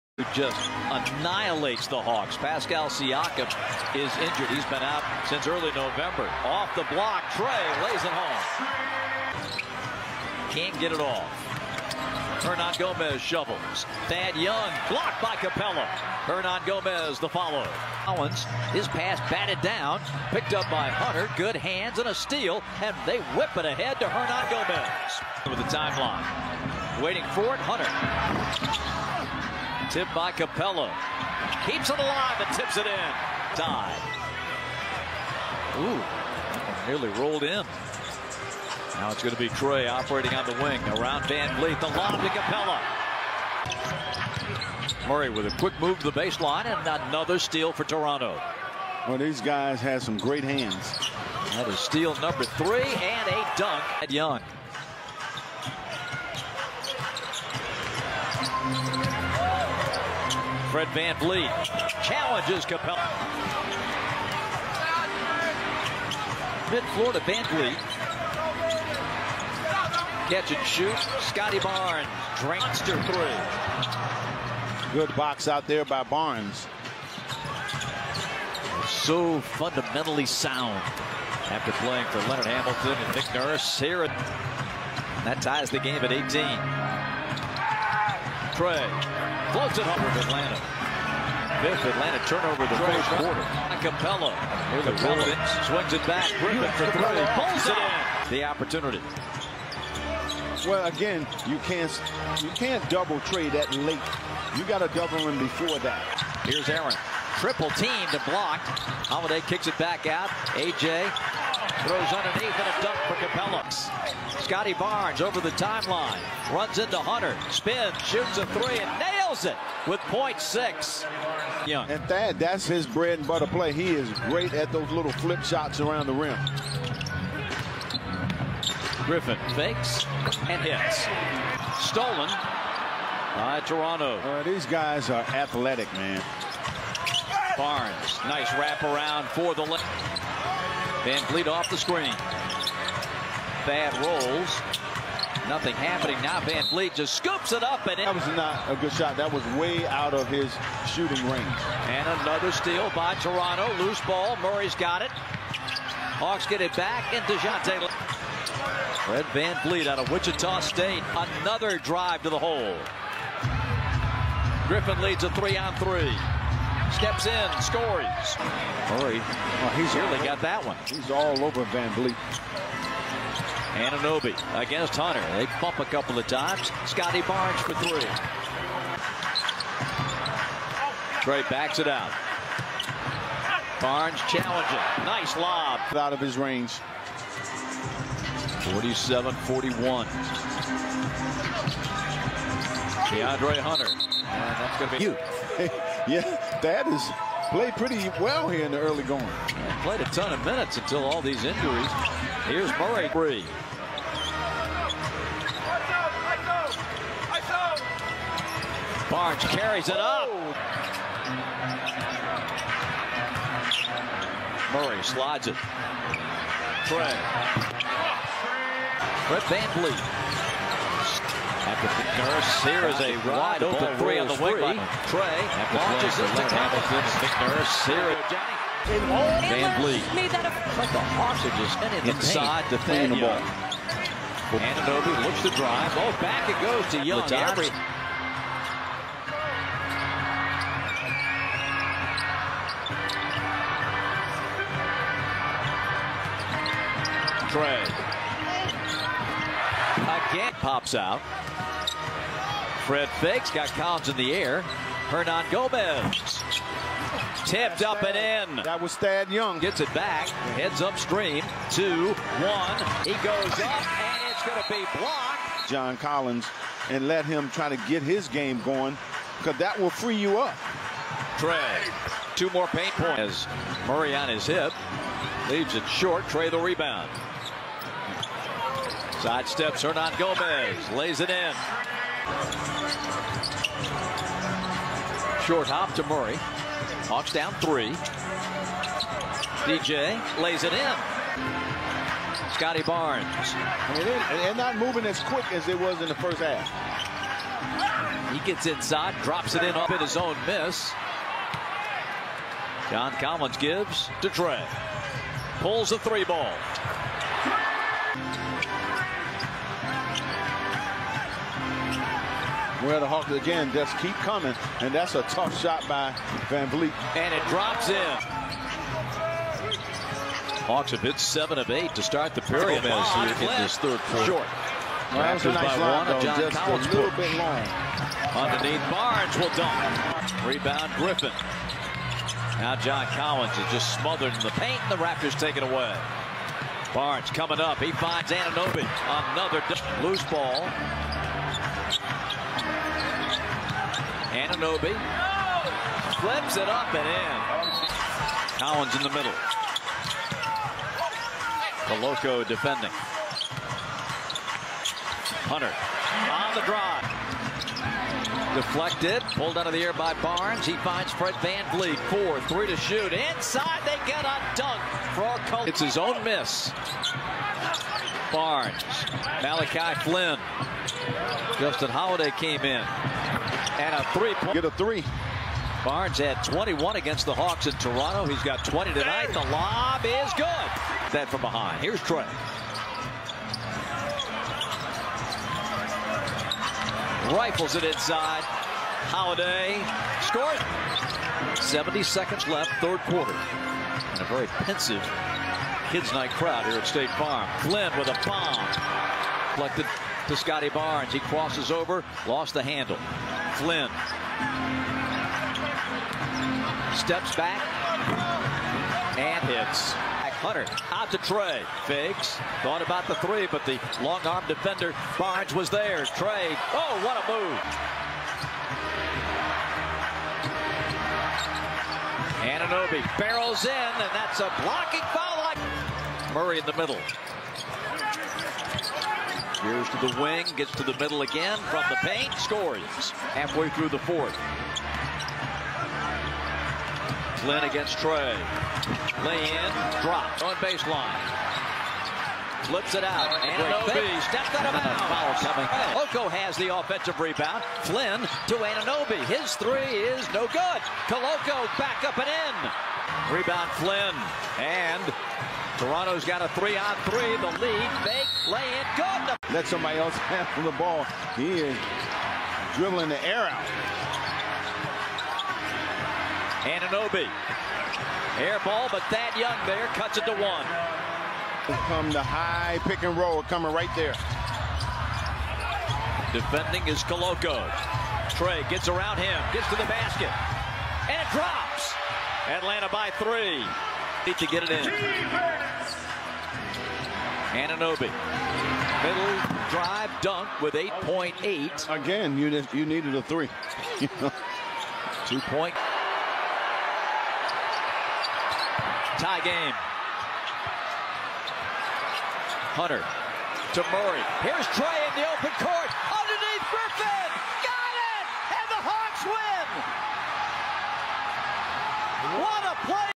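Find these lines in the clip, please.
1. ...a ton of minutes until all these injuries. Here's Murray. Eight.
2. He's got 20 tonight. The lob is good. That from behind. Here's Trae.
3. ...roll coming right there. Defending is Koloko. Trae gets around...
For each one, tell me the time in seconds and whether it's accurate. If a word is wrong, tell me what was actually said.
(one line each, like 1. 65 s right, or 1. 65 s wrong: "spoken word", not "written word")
1. 200 s wrong: "Three", not "Eight"
2. 378 s right
3. 473 s right.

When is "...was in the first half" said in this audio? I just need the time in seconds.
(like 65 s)
295 s.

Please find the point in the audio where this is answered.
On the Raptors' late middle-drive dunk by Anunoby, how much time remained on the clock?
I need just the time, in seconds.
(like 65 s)
490 s.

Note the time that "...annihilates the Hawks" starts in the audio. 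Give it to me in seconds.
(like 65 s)
0 s.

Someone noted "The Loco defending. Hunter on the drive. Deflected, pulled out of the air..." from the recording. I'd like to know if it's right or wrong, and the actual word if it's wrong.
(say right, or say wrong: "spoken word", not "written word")
right.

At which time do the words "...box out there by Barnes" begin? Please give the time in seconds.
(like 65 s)
75 s.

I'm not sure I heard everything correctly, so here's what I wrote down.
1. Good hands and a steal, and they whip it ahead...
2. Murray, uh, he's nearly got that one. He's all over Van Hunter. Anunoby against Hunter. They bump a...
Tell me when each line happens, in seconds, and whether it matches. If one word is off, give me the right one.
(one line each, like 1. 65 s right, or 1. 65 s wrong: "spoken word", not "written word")
1. 21 s right
2. 168 s wrong: "Vliet", not "Hunter".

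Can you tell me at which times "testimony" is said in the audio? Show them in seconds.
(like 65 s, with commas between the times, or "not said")
not said.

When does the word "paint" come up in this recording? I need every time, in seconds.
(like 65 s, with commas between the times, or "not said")
232 s, 272 s, 334 s, 431 s.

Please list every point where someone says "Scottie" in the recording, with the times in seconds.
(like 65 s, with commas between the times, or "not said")
71 s, 114 s, 176 s, 292 s, 400 s.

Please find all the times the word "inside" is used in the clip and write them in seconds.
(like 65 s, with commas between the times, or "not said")
232 s, 298 s, 363 s, 387 s.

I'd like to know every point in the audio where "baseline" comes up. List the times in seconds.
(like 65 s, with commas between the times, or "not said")
46 s, 440 s.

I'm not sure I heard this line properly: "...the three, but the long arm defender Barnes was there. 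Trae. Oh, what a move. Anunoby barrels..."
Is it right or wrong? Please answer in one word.
right.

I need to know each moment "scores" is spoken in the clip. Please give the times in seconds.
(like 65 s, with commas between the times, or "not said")
167 s, 390 s, 432 s.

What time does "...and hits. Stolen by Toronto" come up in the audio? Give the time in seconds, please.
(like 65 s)
130 s.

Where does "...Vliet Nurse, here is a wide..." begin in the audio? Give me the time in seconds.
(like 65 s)
219 s.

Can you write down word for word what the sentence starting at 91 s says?
Fifth Atlanta turnover the first quarter.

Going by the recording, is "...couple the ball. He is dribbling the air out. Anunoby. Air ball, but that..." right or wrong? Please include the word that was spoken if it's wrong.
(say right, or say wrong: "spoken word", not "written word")
wrong: "handle", not "couple".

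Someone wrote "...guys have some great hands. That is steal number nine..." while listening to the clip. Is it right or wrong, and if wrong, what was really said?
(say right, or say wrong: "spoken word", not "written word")
wrong: "three", not "nine".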